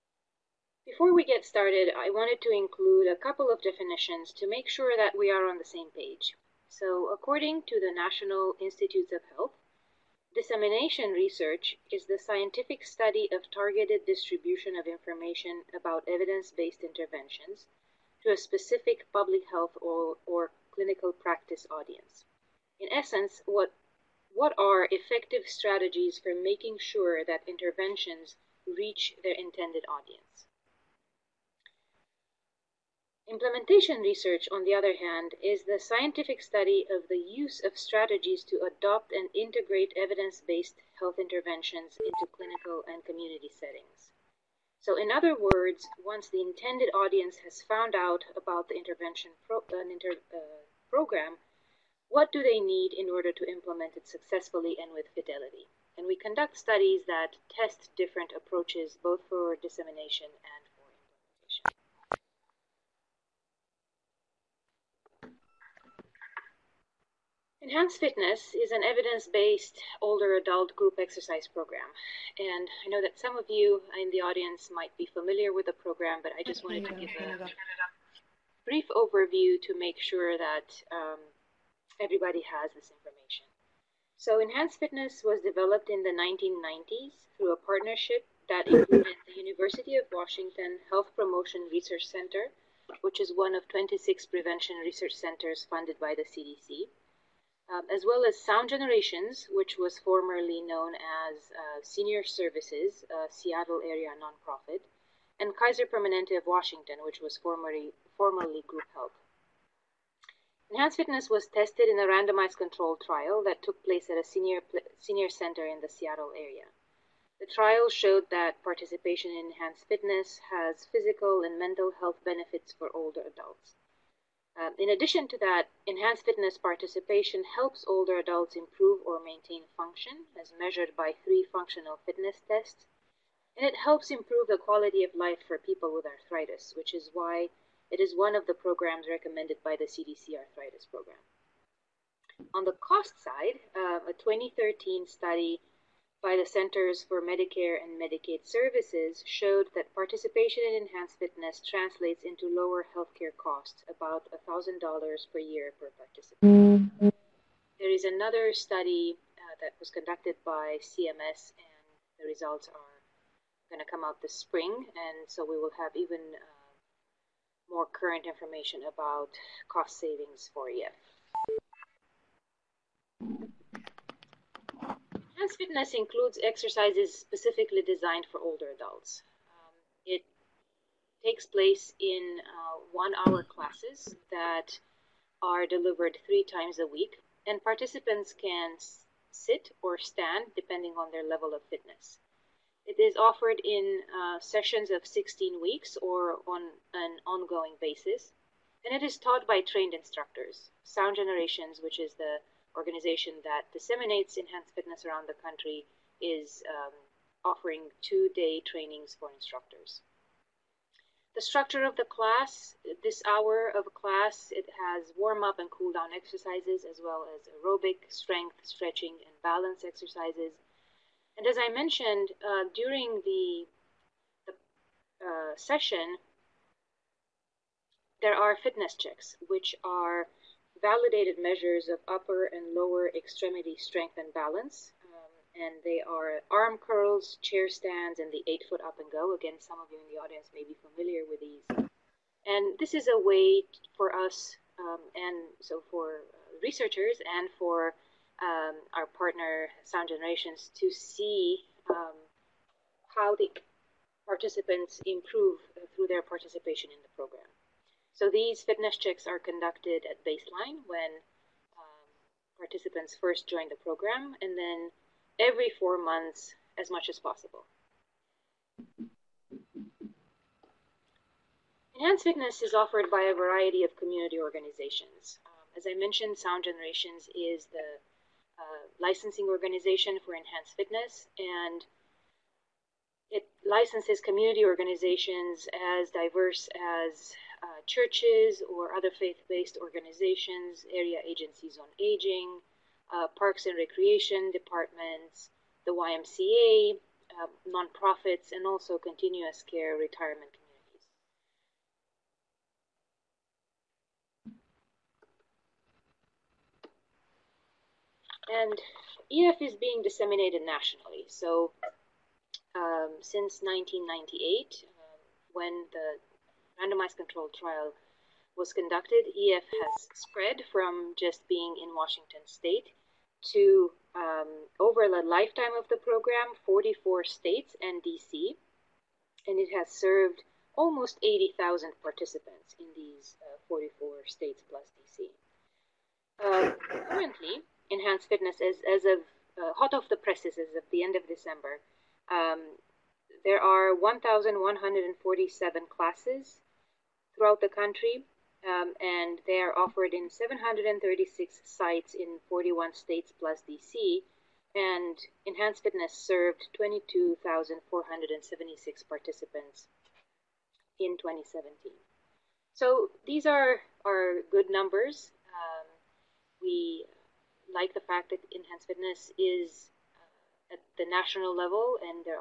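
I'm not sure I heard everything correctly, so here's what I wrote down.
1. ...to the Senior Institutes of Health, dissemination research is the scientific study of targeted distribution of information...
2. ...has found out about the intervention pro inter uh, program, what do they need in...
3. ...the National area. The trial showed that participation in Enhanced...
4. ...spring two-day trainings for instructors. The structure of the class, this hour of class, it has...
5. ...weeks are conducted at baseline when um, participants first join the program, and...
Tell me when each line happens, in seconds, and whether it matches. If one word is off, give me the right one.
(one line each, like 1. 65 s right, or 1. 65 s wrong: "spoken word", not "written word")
1. 7 s wrong: "National", not "Senior"
2. 47 s right
3. 115 s wrong: "Seattle", not "National"
4. 207 s wrong: "offering", not "spring"
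5. 258 s wrong: "checks", not "weeks".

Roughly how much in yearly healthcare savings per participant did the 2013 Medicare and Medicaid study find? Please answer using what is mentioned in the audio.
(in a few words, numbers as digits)
$1,000.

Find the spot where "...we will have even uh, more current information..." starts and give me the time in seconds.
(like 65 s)
165 s.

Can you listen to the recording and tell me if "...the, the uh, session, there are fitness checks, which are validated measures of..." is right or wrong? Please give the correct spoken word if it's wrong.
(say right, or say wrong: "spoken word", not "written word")
right.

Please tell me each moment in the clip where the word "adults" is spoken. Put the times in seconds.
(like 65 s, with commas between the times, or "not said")
70 s, 123 s, 128 s, 178 s.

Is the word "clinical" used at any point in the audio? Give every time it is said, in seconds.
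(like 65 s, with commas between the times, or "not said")
20 s, 42 s.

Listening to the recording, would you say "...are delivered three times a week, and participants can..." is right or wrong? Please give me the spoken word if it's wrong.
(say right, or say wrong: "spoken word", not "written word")
right.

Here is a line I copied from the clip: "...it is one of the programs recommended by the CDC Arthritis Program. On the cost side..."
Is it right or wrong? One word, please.
right.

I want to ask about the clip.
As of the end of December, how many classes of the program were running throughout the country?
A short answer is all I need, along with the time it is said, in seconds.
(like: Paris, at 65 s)
1,147, at 343 s.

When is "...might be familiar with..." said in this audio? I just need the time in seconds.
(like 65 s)
74 s.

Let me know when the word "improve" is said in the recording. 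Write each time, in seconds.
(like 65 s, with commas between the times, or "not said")
128 s, 134 s, 255 s.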